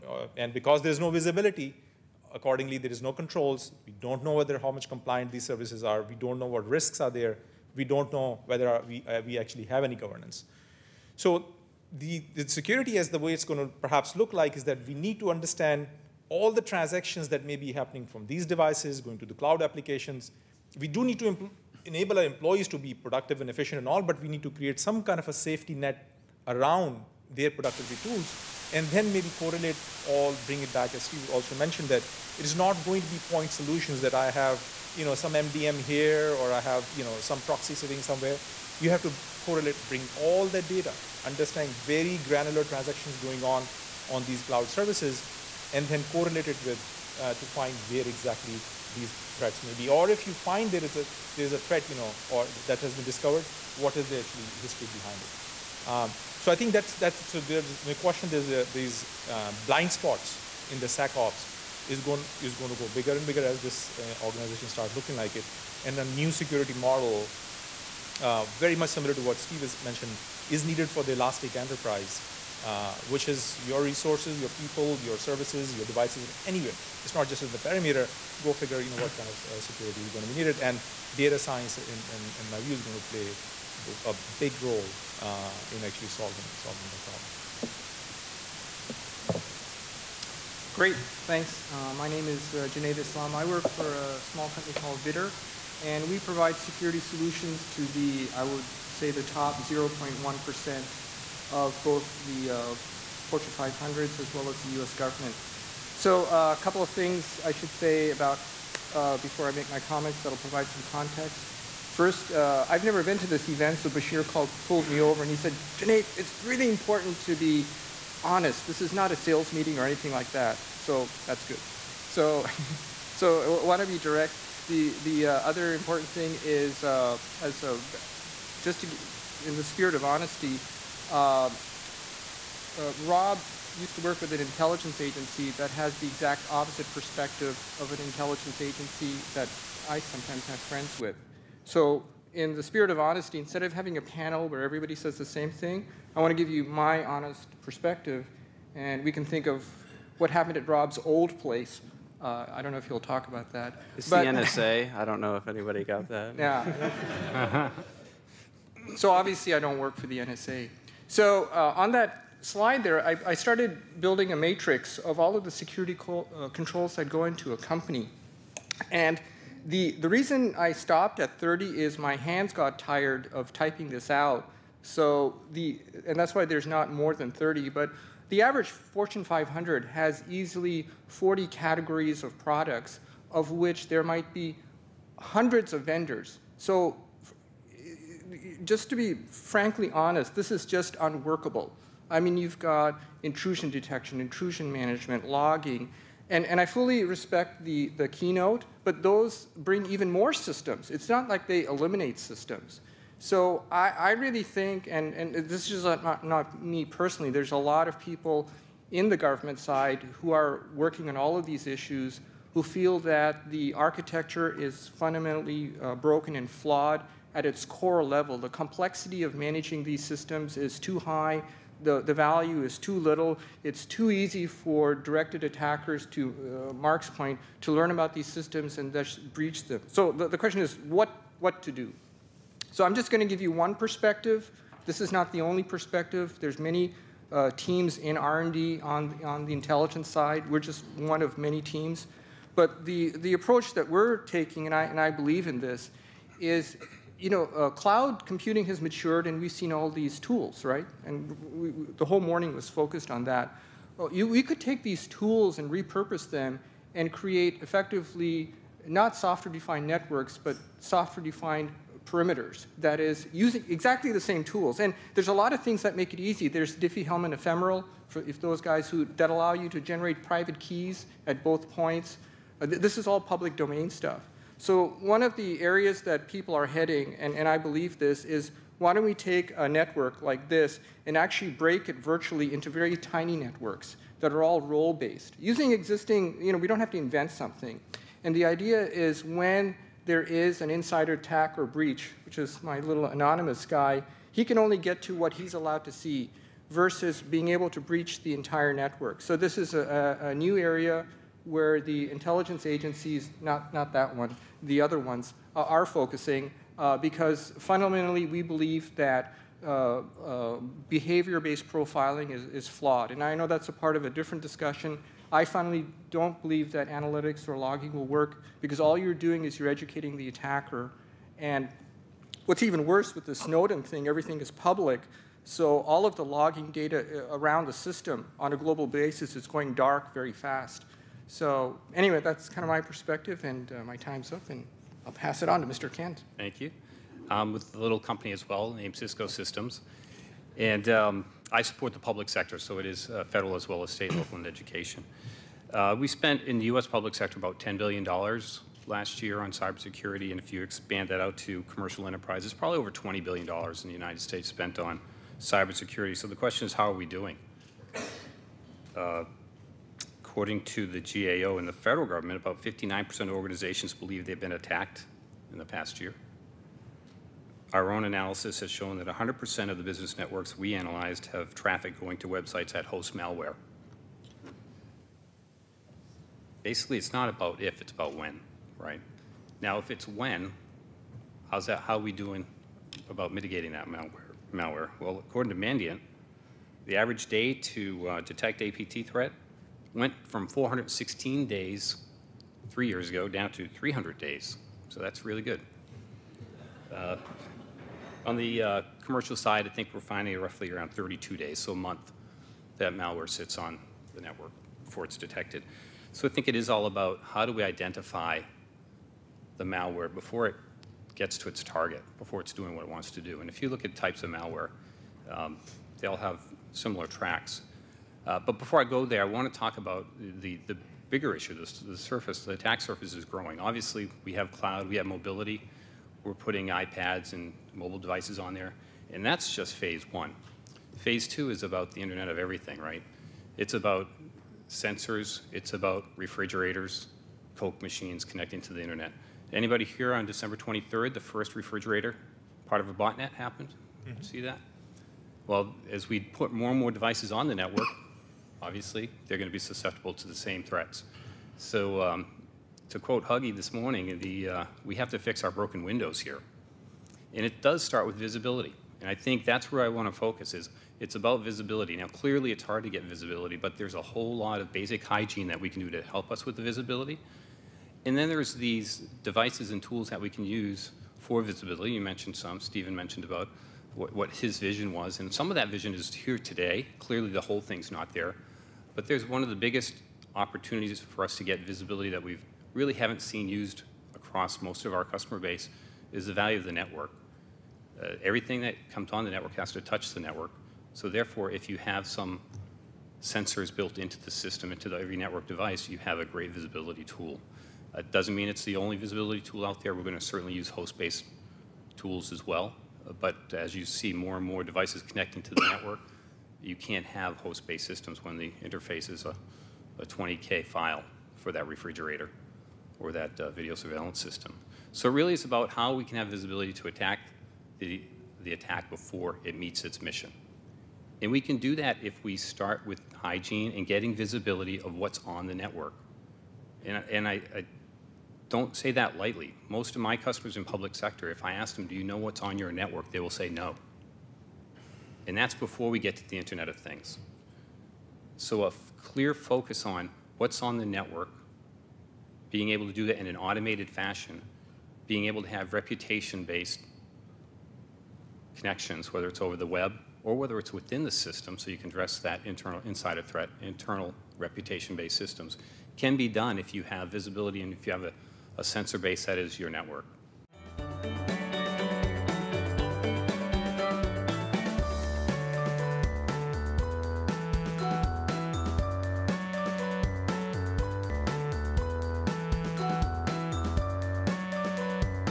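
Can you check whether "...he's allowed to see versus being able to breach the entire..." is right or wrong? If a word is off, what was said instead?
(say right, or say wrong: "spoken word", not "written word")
right.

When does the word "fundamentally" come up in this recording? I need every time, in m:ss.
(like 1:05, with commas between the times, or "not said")
3:34, 5:07.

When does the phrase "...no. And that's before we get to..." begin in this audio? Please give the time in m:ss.
8:53.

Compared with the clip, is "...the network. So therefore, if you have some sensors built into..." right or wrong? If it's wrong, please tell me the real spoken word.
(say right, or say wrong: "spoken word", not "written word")
right.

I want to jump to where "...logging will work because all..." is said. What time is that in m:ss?
5:17.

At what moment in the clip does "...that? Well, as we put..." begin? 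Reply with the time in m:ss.
7:24.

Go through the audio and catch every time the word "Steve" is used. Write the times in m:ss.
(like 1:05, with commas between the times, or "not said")
0:31, 1:09.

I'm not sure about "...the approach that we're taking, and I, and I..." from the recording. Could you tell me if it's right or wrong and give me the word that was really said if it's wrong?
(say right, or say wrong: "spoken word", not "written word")
right.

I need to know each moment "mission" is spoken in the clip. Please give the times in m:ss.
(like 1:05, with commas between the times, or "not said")
8:40.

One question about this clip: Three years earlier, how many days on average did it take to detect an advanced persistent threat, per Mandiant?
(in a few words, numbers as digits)
416.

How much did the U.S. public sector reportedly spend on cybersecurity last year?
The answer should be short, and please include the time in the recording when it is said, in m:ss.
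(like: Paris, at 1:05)
$10 billion, at 5:47.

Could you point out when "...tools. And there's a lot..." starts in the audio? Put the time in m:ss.
4:24.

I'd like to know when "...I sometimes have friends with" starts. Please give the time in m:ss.
2:19.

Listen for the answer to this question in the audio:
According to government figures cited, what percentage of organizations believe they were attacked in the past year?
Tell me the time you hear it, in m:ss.
6:02.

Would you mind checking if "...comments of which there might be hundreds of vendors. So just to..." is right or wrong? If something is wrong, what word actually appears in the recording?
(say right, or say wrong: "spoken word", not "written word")
wrong: "products", not "comments".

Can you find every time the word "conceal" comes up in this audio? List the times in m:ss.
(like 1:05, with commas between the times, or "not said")
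not said.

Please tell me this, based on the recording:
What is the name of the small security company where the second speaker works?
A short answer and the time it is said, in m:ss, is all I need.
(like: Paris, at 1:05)
Vidder, at 1:35.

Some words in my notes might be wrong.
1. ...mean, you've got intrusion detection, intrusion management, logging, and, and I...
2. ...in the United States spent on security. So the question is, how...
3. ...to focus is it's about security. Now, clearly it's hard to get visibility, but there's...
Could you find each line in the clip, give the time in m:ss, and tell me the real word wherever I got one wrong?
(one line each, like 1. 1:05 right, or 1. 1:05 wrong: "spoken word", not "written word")
1. 3:12 right
2. 5:53 wrong: "cybersecurity", not "security"
3. 7:40 wrong: "visibility", not "security".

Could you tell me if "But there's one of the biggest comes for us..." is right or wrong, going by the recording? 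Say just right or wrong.
wrong.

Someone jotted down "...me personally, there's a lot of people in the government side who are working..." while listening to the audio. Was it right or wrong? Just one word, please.
right.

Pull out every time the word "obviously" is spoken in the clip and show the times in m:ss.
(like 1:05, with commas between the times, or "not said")
2:39, 7:03, 7:28.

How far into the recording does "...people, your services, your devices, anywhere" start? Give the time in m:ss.
1:14.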